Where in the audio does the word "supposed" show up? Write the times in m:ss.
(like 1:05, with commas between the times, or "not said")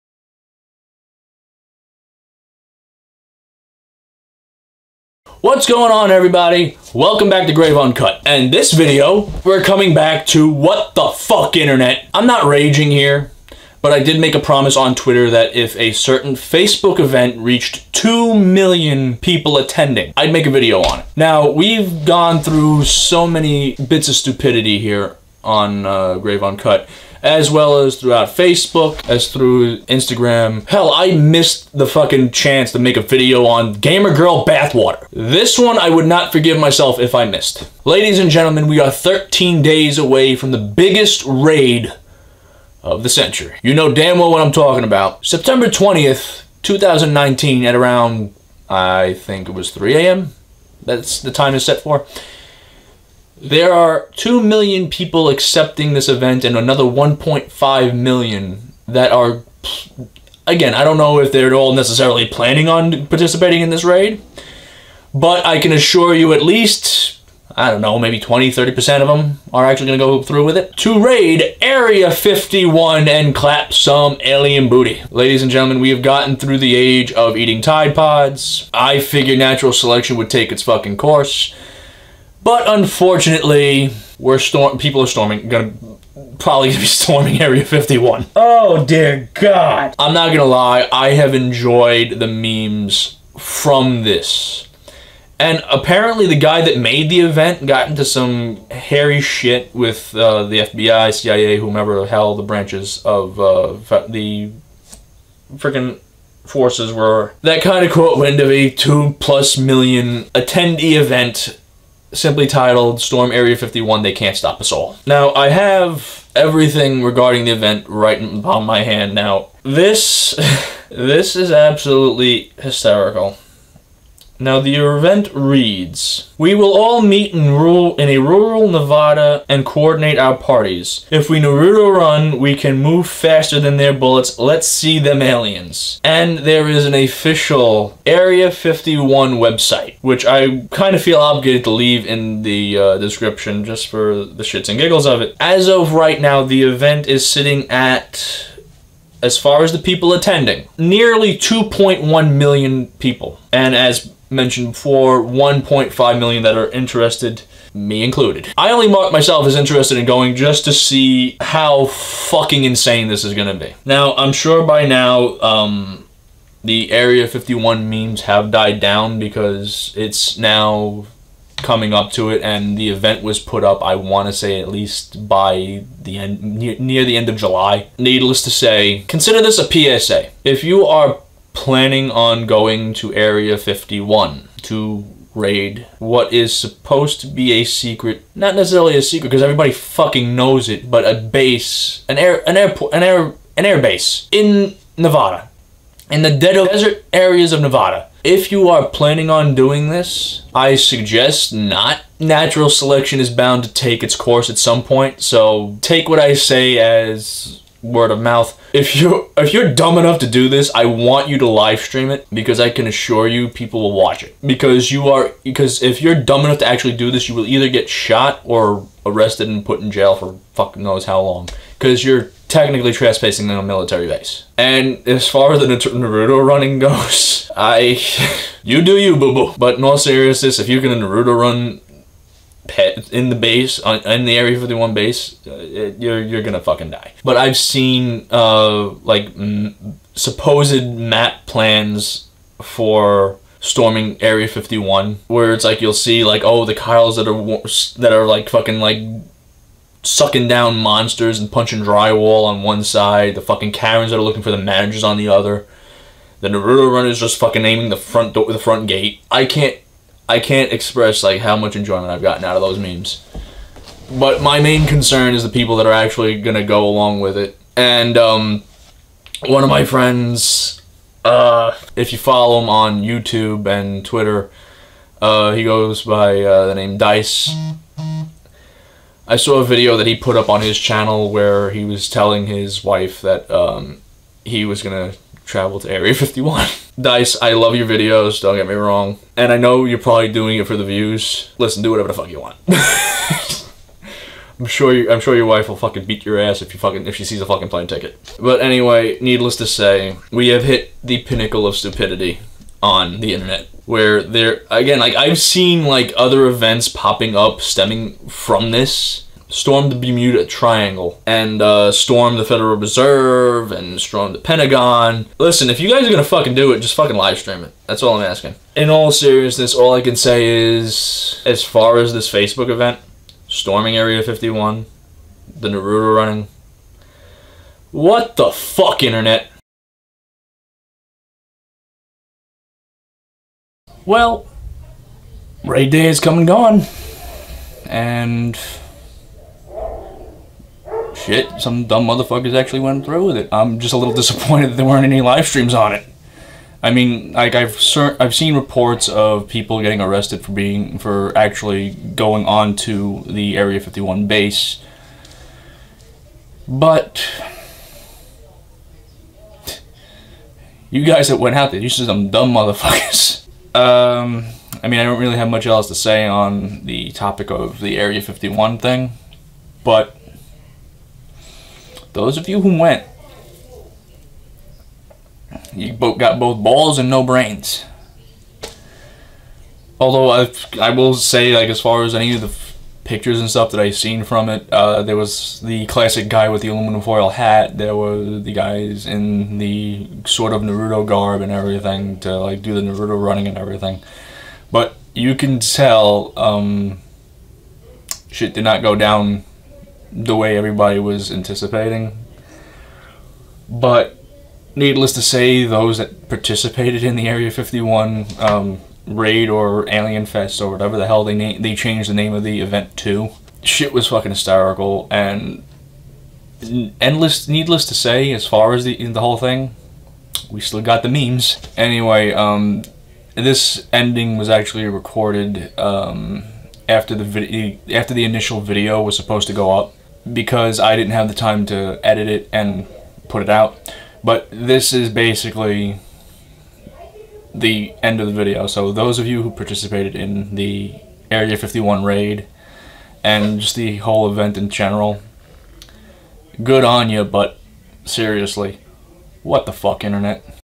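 3:06, 4:00, 7:09.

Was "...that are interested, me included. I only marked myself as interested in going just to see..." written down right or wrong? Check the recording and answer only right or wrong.
right.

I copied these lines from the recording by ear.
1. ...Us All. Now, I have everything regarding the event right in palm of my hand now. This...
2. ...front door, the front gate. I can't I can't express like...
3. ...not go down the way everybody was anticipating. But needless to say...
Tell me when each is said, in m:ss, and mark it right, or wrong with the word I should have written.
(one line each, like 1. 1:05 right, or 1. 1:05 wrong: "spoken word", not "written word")
1. 1:54 right
2. 4:17 right
3. 6:38 right.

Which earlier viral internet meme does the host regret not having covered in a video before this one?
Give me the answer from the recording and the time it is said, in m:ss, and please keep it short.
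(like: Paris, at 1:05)
Gamer Girl Bathwater, at 0:33.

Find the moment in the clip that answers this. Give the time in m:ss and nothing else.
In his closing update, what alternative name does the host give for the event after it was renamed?
6:49.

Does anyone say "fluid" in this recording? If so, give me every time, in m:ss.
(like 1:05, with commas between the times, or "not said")
not said.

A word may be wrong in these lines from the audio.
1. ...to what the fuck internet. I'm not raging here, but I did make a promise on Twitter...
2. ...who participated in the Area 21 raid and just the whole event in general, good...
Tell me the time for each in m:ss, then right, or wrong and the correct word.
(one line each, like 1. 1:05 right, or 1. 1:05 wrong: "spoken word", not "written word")
1. 0:10 right
2. 7:19 wrong: "51", not "21".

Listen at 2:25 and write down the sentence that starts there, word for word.
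As of right now, the event is sitting at as far as the people attending, nearly 2.1 million people.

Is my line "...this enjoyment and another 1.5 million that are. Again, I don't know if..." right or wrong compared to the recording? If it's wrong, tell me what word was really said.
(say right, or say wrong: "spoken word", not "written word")
wrong: "event", not "enjoyment".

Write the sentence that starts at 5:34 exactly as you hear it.
Well, raid Day is coming, and gone.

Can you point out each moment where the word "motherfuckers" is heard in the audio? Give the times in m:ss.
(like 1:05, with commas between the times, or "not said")
5:42, 6:02.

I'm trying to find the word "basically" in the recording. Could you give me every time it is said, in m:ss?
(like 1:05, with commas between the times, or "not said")
7:15.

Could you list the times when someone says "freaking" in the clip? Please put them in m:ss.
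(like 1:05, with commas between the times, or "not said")
1:45.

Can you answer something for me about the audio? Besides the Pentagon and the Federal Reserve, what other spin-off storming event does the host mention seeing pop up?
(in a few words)
Bermuda Triangle.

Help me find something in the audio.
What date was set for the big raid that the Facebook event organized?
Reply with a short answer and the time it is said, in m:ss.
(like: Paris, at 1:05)
September 20th, 2019, at 0:45.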